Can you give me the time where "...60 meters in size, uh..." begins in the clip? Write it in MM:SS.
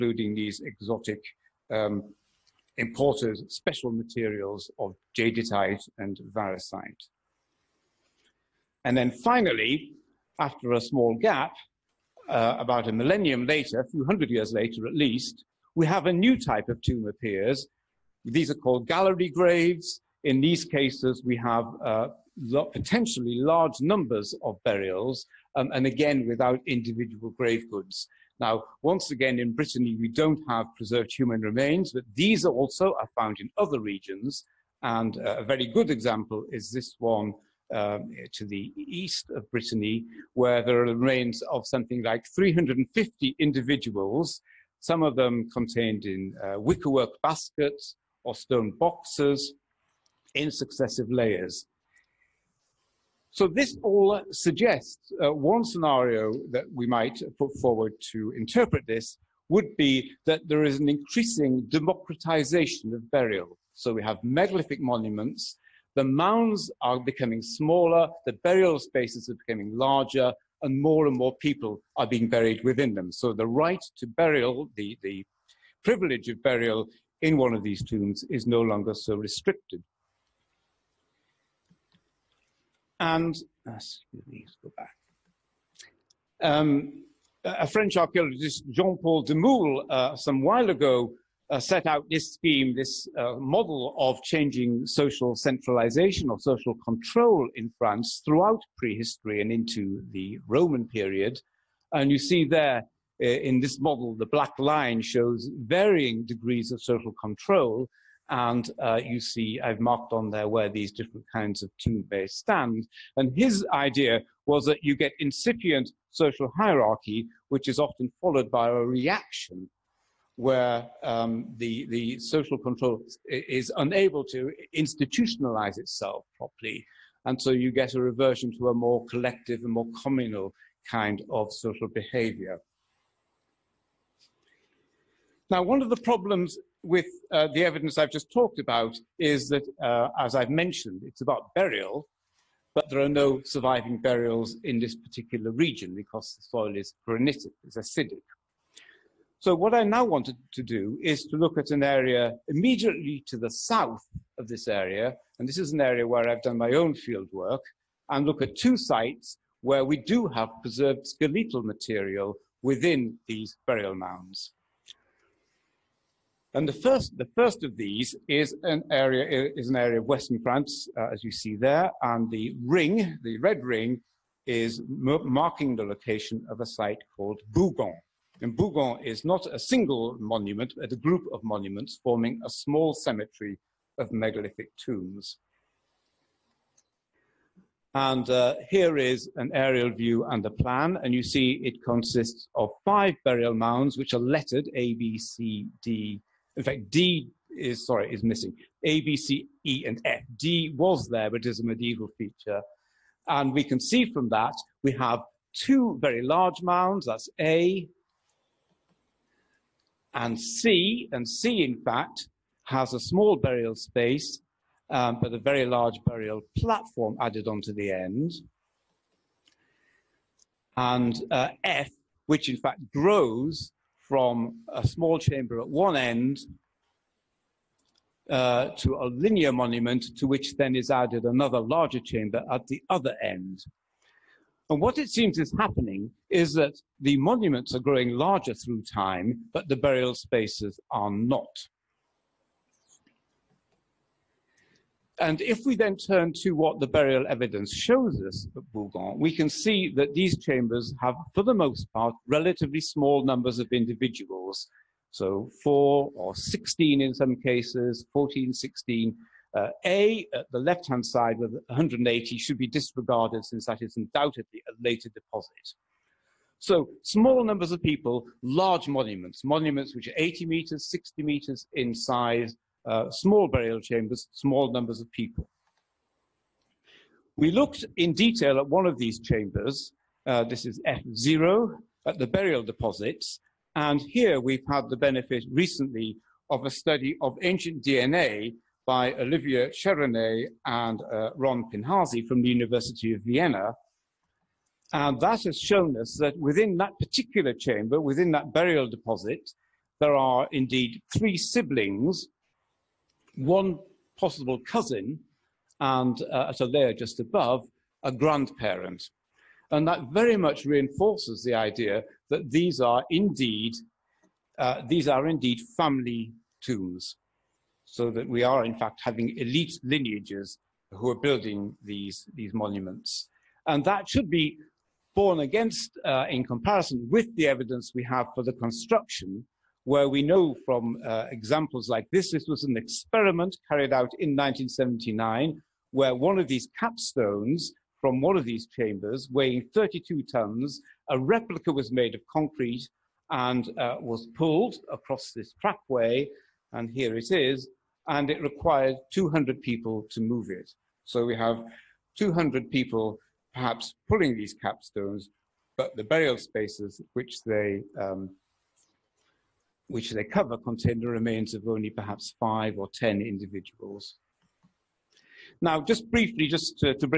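04:30.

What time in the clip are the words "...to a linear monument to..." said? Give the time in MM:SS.
03:48.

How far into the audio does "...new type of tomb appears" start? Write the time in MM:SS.
00:16.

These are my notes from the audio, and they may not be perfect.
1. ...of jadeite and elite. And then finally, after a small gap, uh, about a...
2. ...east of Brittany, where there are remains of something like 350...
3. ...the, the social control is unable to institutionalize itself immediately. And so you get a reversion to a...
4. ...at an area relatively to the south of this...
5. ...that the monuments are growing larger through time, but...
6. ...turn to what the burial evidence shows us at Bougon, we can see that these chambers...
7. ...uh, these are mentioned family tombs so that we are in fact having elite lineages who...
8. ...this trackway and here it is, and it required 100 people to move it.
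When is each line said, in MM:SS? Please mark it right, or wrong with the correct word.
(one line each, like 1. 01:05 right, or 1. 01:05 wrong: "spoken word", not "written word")
1. 00:04 wrong: "variscite", not "elite"
2. 00:38 right
3. 02:01 wrong: "properly", not "immediately"
4. 02:31 wrong: "immediately", not "relatively"
5. 03:56 right
6. 04:05 right
7. 05:14 wrong: "indeed", not "mentioned"
8. 05:45 wrong: "200", not "100".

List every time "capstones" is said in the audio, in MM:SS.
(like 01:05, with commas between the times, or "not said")
05:36, 05:54.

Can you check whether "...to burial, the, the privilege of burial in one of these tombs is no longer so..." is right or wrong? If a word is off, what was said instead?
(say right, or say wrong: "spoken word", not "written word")
right.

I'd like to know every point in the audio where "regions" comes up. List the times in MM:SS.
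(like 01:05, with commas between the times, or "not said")
00:33, 02:25.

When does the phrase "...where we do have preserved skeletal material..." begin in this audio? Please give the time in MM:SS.
02:39.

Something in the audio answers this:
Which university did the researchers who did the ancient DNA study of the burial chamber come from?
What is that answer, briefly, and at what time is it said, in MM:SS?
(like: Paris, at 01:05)
University of Vienna, at 04:52.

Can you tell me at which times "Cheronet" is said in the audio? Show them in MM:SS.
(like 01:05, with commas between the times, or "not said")
04:49.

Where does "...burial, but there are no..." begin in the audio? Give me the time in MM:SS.
02:21.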